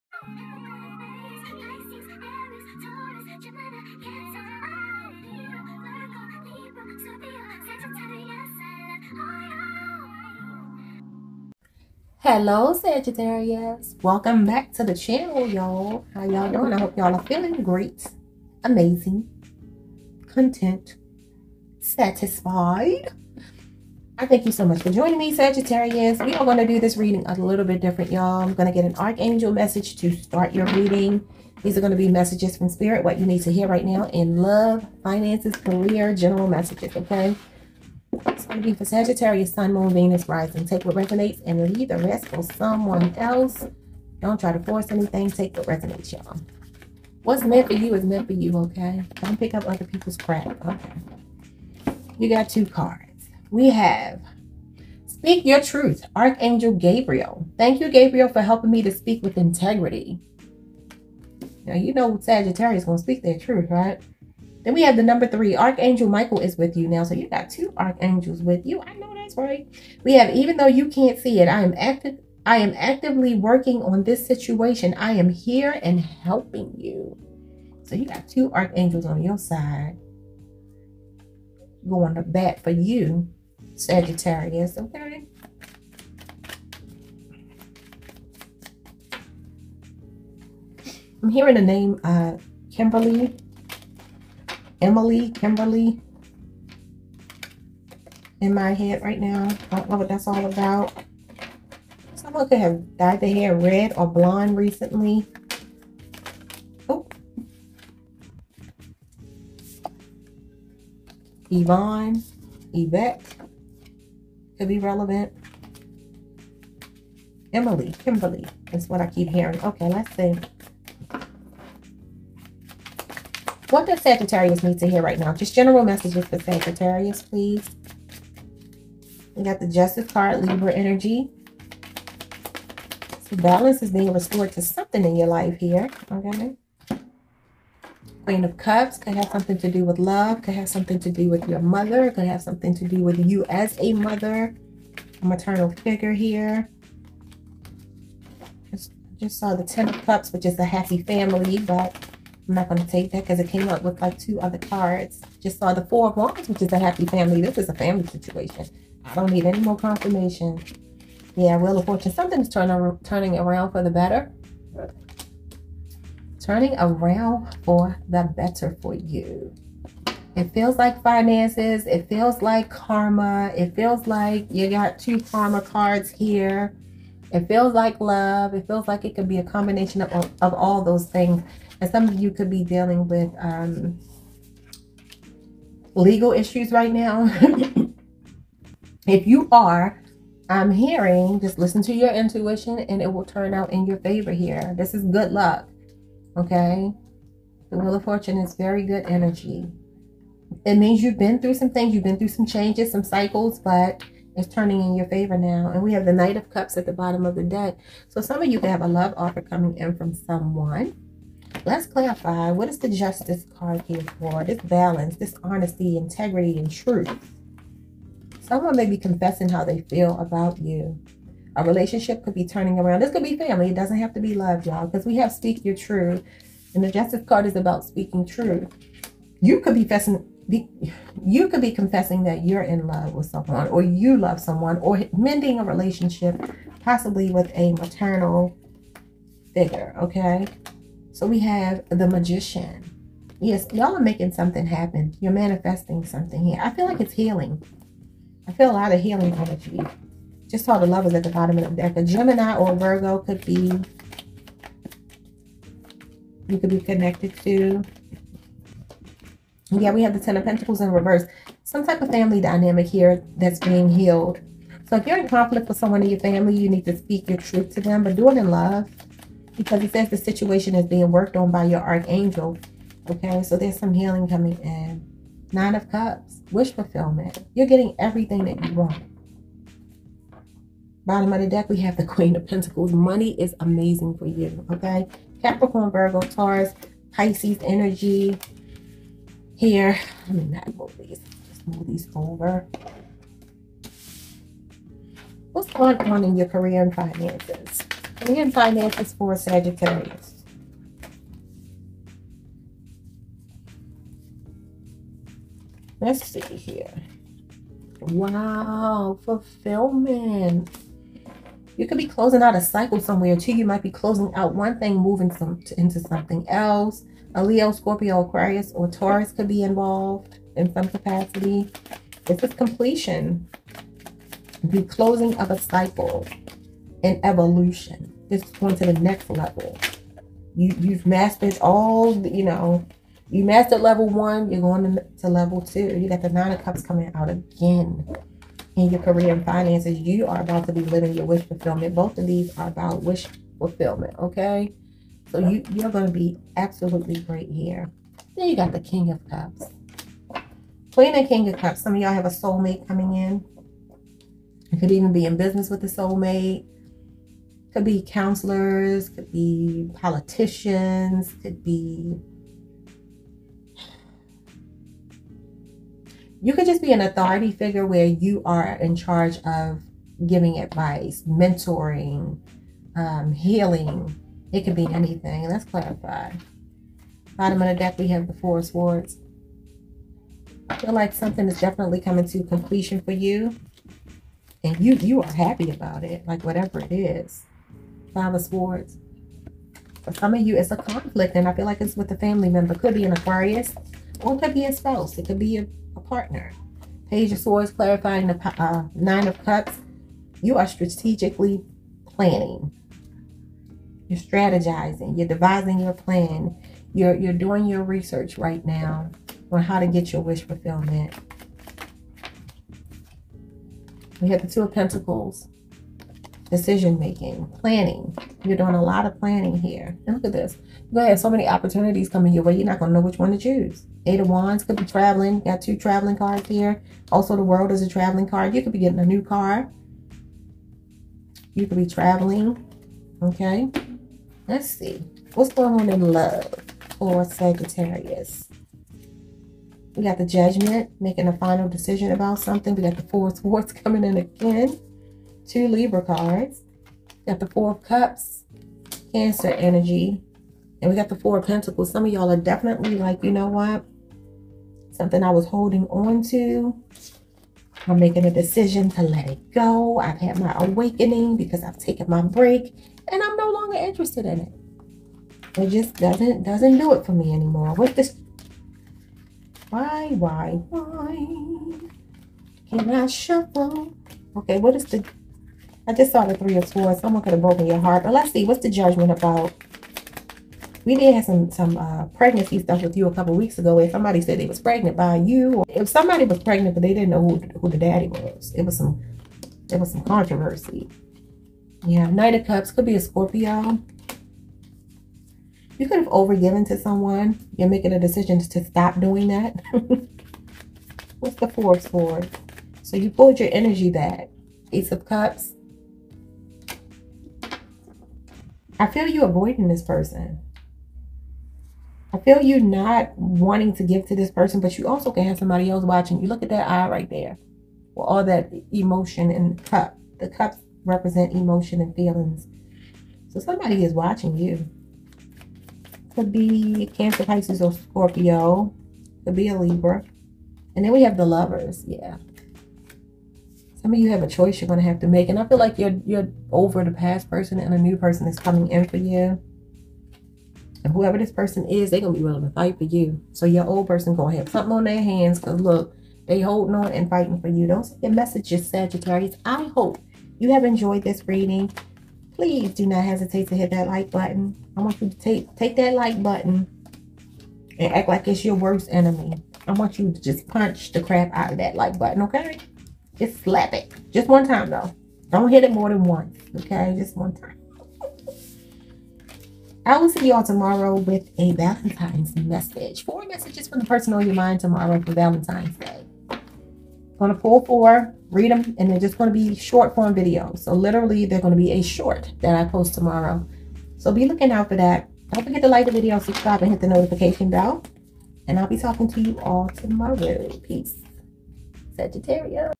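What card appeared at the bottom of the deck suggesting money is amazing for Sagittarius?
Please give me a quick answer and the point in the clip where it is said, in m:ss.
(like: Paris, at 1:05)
Queen of Pentacles, at 4:42.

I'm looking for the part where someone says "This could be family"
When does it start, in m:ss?
3:43.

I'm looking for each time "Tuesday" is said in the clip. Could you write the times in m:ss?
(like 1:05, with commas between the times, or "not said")
not said.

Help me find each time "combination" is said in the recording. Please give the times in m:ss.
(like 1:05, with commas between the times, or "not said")
2:59.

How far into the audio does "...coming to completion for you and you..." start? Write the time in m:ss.
6:22.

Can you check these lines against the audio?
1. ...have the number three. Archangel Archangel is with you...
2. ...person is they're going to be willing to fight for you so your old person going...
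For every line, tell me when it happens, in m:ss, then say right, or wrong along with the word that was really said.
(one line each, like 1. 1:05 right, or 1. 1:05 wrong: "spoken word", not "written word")
1. 1:04 wrong: "Michael", not "Archangel"
2. 9:01 right.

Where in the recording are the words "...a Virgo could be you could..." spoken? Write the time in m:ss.
4:12.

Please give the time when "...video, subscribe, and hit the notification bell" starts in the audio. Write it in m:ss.
9:45.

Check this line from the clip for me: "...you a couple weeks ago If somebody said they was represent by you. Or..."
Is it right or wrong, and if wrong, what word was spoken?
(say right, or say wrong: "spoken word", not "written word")
wrong: "pregnant", not "represent".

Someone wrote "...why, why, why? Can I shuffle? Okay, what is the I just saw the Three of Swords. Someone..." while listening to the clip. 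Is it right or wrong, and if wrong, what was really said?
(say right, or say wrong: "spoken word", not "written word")
right.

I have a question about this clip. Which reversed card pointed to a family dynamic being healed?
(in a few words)
Ten of Pentacles.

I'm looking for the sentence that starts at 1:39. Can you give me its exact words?
I don't know what that's all about.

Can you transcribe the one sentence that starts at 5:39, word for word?
You are about to be living your wish fulfillment.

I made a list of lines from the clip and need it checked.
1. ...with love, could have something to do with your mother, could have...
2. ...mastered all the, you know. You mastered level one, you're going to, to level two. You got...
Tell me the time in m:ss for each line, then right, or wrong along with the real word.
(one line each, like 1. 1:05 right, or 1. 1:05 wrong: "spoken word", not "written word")
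1. 2:19 right
2. 5:31 right.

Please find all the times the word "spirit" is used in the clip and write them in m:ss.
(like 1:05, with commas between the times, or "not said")
0:32.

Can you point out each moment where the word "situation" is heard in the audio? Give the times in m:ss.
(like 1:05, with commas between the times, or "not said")
1:14, 2:38, 4:30.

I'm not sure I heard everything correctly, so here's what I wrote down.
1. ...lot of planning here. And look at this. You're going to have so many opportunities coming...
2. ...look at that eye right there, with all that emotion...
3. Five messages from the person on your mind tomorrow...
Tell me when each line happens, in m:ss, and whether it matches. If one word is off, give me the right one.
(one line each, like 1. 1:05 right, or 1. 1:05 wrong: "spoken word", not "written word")
1. 6:58 right
2. 8:36 right
3. 9:33 wrong: "Four", not "Five".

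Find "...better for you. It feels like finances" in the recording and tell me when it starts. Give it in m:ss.
2:48.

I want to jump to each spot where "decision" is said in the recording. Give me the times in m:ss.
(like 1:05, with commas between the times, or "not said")
6:56, 7:21, 7:38, 8:17.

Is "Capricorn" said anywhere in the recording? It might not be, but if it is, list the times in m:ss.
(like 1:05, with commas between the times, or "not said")
4:45.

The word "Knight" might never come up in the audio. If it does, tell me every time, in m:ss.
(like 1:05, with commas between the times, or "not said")
3:26, 8:12.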